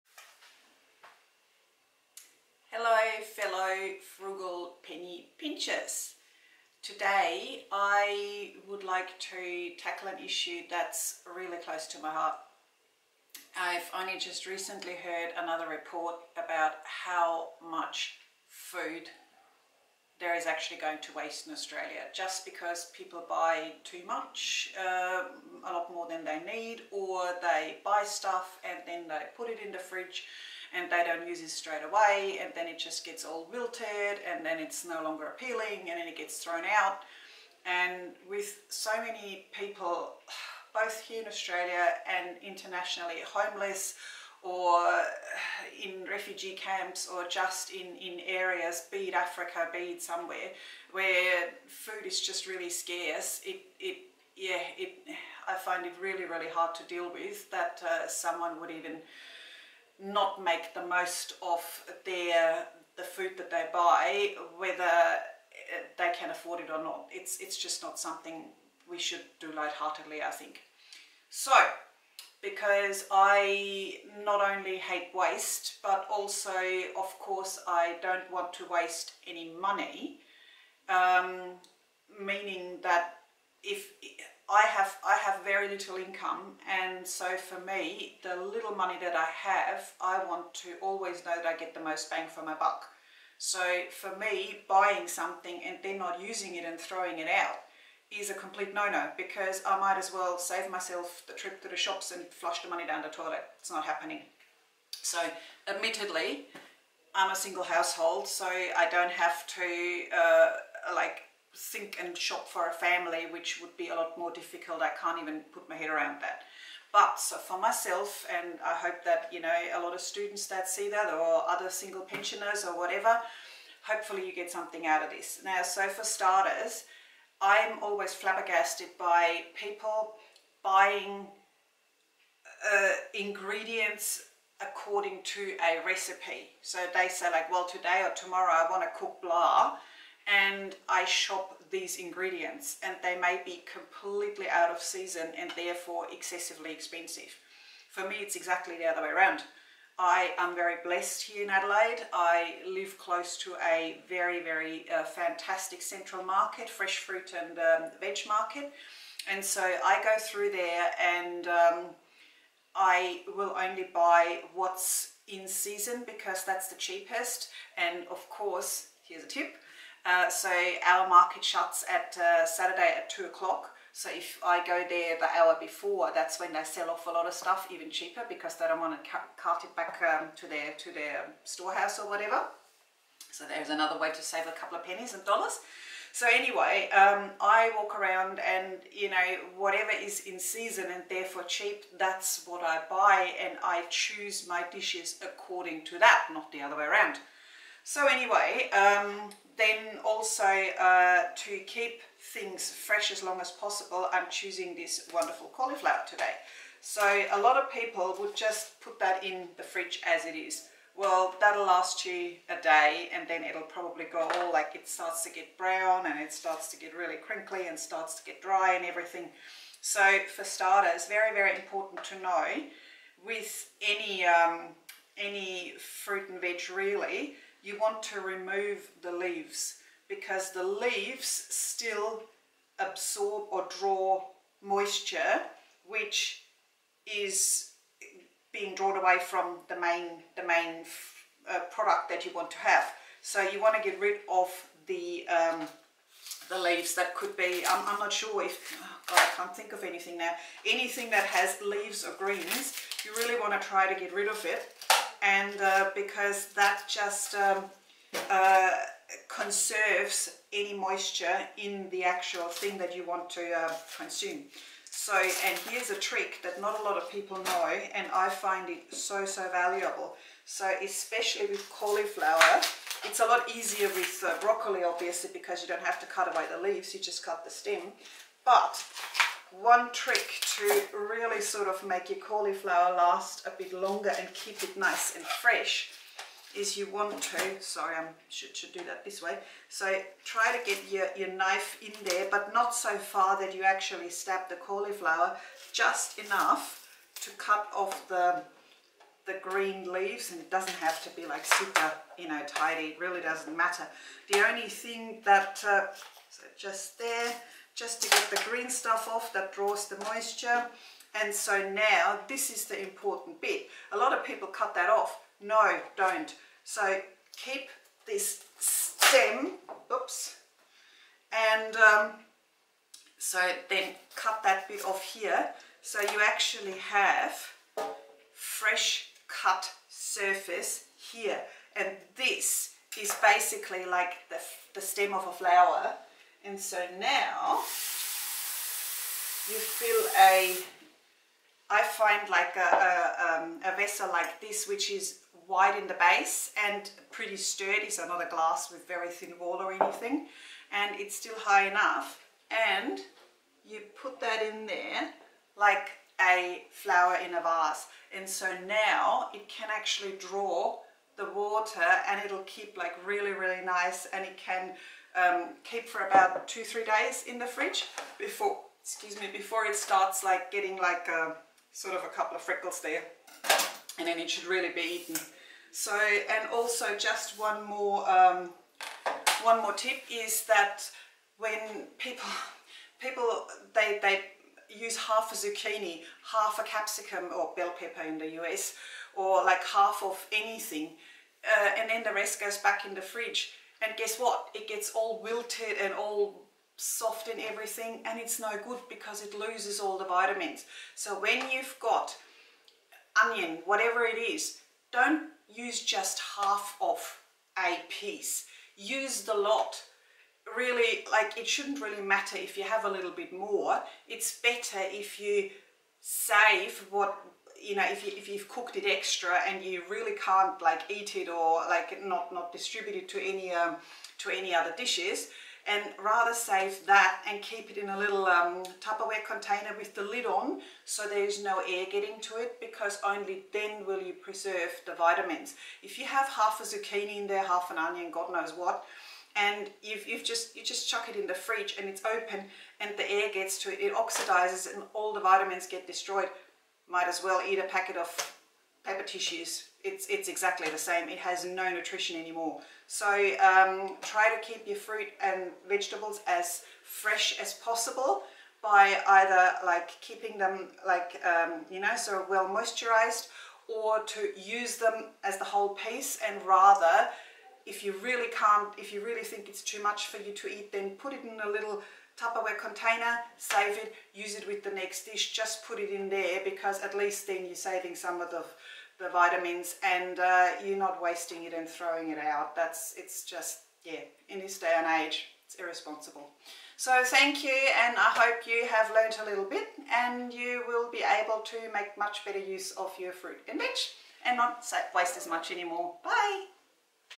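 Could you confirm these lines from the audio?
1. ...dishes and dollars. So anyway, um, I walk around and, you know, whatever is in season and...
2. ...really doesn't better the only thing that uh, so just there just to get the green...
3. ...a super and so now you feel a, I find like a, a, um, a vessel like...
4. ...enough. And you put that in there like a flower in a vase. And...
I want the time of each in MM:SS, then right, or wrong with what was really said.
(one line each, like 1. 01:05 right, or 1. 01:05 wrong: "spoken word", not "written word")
1. 03:04 wrong: "pennies", not "dishes"
2. 05:02 wrong: "matter", not "better"
3. 05:35 wrong: "flower", not "super"
4. 05:51 right.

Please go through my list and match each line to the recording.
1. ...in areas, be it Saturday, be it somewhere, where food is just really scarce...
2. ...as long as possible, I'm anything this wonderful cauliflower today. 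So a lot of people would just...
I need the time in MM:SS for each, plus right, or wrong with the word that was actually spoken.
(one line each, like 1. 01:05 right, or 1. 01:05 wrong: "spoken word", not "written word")
1. 00:47 wrong: "Africa", not "Saturday"
2. 03:23 wrong: "choosing", not "anything".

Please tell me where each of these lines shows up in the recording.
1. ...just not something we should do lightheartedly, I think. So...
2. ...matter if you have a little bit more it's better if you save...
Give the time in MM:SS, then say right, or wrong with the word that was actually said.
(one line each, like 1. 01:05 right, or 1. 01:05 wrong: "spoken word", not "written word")
1. 01:07 right
2. 06:52 right.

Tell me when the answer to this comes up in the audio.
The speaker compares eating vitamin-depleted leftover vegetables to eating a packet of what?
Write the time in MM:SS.
07:28.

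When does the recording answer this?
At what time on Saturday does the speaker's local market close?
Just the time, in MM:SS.
02:53.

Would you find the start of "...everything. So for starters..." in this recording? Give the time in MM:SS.
03:38.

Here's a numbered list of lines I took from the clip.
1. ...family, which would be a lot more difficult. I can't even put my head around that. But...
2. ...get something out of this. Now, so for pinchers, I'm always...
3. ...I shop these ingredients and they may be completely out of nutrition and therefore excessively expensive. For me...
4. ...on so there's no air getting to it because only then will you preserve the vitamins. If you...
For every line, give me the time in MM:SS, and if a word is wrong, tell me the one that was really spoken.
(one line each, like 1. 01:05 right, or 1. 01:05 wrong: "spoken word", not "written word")
1. 01:52 right
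2. 02:04 wrong: "starters", not "pinchers"
3. 02:21 wrong: "season", not "nutrition"
4. 07:10 right.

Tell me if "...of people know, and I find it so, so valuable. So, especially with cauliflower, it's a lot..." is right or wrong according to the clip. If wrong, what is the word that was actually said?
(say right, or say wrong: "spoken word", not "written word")
right.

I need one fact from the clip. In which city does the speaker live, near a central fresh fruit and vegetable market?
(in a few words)
Adelaide.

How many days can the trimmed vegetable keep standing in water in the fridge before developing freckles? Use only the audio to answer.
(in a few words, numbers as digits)
2 to 3 days.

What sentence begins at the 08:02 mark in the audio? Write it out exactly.
That's, it's just, yeah, in this day and age, it's irresponsible.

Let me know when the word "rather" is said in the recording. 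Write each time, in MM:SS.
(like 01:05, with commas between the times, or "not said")
07:06, 07:46.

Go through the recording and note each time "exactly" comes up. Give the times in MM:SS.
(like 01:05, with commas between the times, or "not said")
02:28, 07:30.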